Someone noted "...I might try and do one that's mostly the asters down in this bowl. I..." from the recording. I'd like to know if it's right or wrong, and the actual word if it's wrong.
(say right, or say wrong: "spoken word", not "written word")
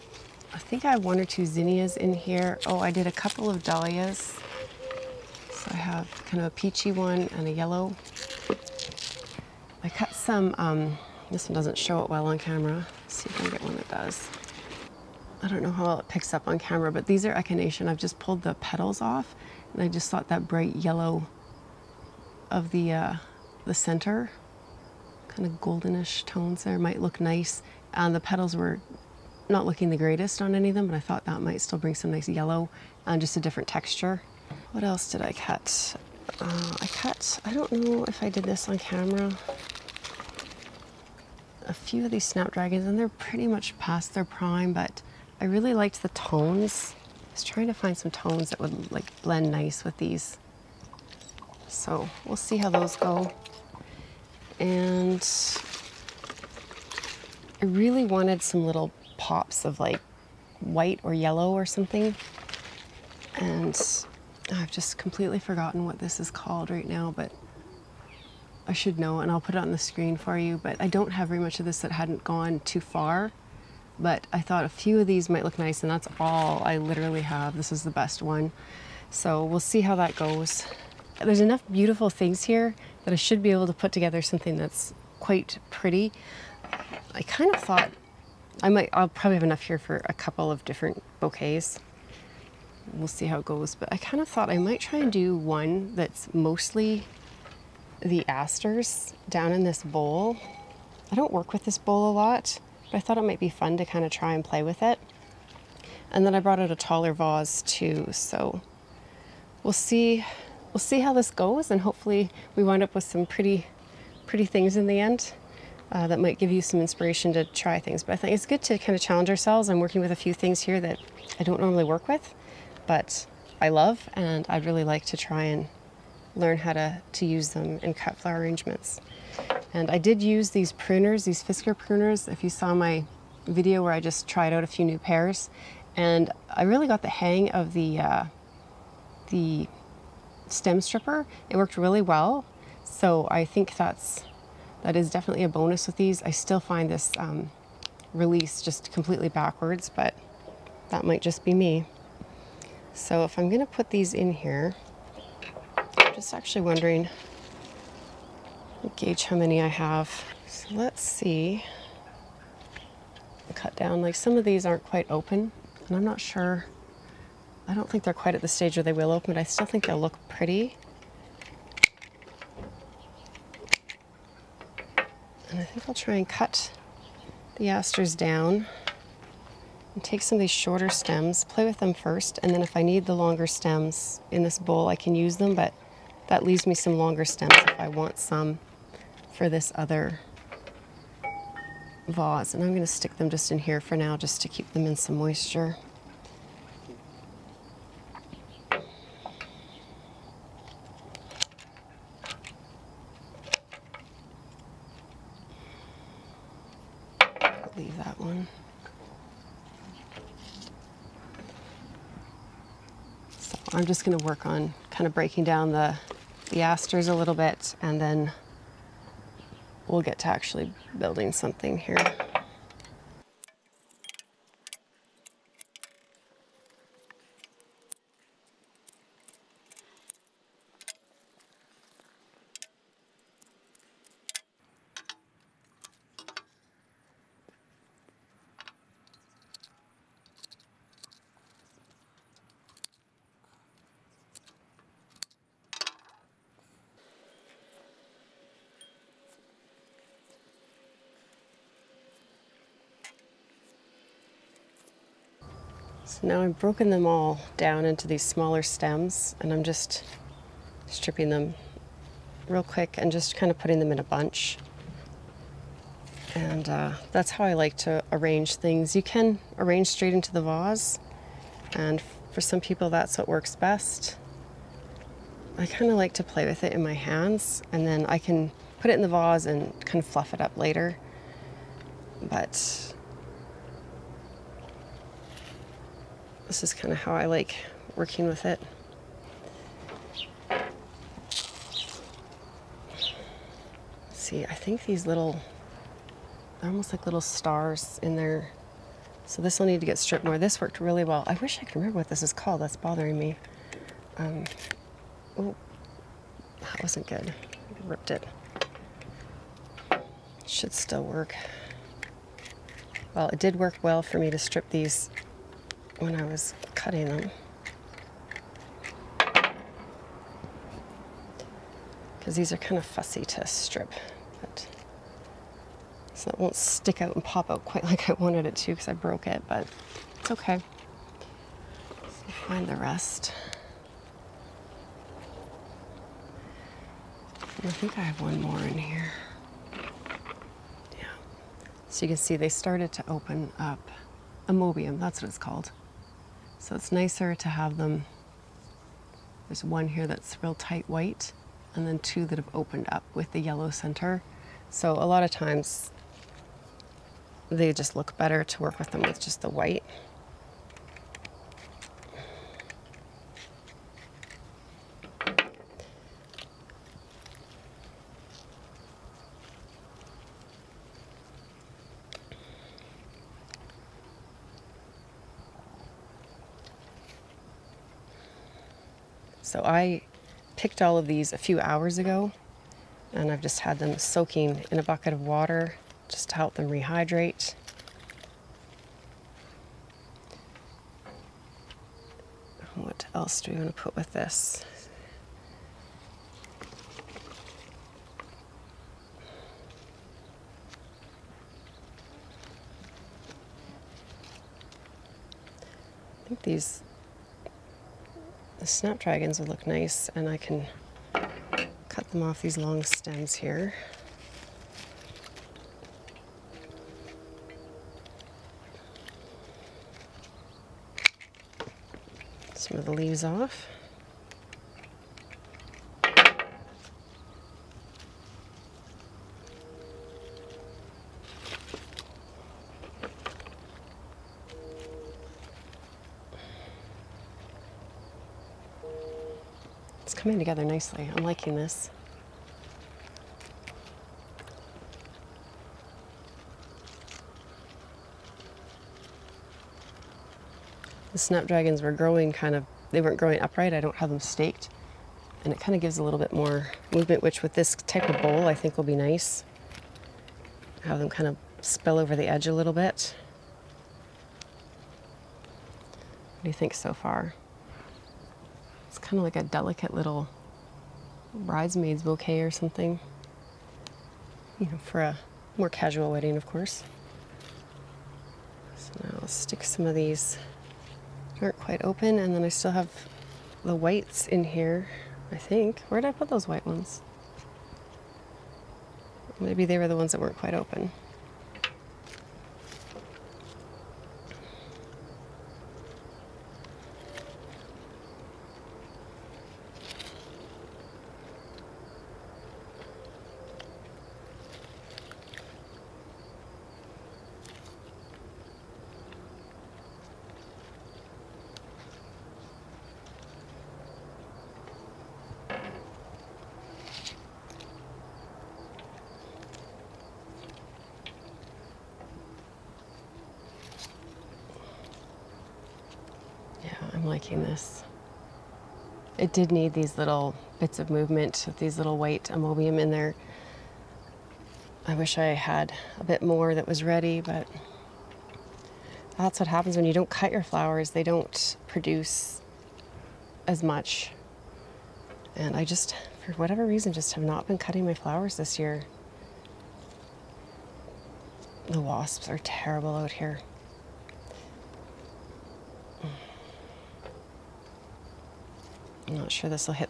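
right.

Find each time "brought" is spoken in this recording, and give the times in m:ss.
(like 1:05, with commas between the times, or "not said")
1:46.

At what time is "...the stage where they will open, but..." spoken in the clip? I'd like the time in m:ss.
2:48.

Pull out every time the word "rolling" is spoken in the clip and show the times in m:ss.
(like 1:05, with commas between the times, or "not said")
not said.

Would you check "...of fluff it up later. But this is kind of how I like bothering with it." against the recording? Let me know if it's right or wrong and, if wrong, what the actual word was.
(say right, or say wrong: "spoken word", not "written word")
wrong: "working", not "bothering".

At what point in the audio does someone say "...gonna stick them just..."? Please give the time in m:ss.
3:12.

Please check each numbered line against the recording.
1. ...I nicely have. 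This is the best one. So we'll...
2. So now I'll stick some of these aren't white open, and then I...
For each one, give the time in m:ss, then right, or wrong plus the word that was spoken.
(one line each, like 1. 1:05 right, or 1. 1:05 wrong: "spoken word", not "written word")
1. 1:16 wrong: "literally", not "nicely"
2. 7:58 wrong: "quite", not "white".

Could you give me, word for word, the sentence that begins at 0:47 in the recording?
I was trying to find some tones that would like blend nice with these so we'll see how those go.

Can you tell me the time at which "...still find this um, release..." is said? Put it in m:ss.
2:26.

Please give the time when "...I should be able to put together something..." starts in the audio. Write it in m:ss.
1:23.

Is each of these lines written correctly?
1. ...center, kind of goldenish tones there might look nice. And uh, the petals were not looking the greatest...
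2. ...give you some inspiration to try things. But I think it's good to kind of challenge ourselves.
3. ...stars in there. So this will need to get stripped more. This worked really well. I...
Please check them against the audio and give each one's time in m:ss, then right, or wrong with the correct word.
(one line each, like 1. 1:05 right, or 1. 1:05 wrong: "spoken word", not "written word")
1. 0:23 right
2. 1:56 right
3. 4:57 right.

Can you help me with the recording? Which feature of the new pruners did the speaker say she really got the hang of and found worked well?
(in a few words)
The stem stripper.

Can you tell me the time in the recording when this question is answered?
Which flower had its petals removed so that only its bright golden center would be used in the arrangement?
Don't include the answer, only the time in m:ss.
0:17.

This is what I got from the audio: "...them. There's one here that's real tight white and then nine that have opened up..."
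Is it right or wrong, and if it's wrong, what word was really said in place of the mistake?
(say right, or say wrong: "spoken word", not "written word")
wrong: "two", not "nine".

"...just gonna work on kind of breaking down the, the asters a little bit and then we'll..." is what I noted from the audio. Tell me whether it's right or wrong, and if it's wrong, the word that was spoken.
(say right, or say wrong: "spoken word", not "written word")
right.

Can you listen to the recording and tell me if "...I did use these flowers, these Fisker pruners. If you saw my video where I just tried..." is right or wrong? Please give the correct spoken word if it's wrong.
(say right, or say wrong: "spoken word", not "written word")
wrong: "pruners", not "flowers".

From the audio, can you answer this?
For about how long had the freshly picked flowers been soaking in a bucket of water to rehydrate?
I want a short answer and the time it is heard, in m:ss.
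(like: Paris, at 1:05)
A few hours, at 6:21.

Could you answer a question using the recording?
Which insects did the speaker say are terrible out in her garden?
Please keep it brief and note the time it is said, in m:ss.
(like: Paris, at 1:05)
Wasps, at 9:11.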